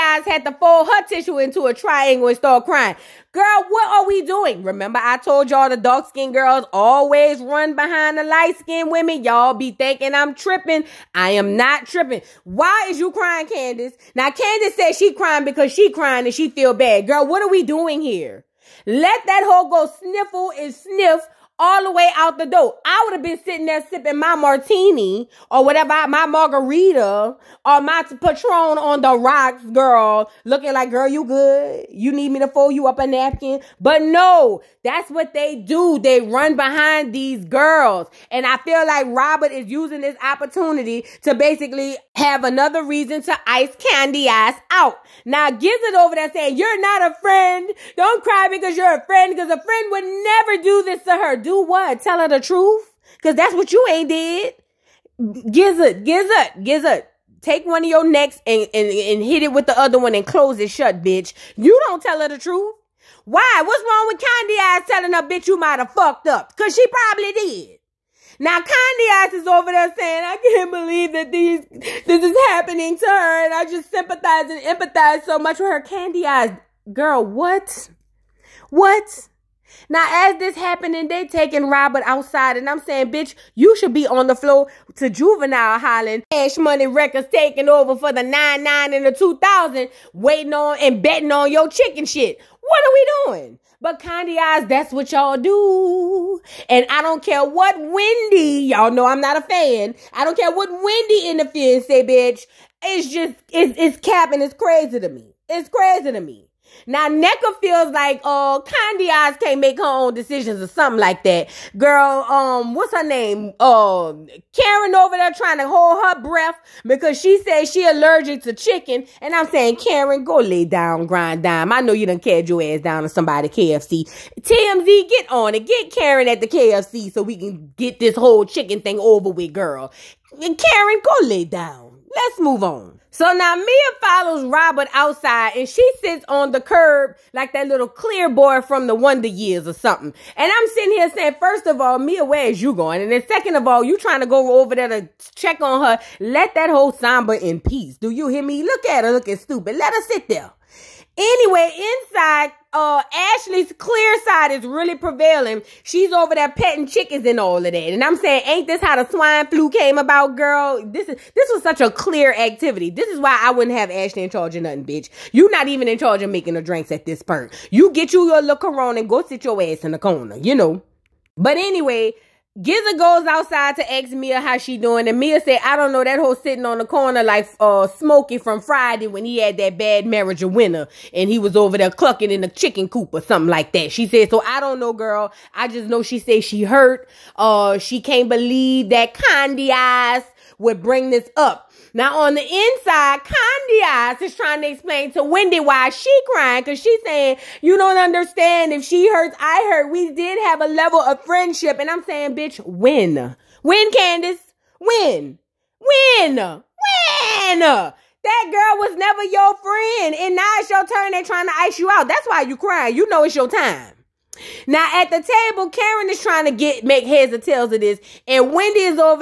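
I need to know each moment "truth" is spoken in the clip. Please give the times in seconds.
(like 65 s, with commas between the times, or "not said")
52 s, 62 s.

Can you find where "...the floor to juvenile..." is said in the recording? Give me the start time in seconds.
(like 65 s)
84 s.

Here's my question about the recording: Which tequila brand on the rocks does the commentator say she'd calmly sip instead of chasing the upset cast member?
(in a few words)
Patron.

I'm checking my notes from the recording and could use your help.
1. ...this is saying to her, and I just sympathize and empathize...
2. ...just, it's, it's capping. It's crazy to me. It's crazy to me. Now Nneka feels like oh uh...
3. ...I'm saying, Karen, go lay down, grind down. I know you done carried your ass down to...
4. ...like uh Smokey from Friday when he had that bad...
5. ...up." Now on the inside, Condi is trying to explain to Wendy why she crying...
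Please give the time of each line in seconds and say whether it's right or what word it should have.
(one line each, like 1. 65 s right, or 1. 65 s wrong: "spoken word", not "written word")
1. 72 s wrong: "happening", not "saying"
2. 103 s right
3. 119 s right
4. 177 s right
5. 191 s right.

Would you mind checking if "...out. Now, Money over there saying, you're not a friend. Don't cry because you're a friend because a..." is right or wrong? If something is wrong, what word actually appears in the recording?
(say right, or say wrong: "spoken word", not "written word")
wrong: "Gizzard", not "Money".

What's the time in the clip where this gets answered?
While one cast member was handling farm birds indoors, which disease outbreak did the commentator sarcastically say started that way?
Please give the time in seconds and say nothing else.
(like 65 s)
159 s.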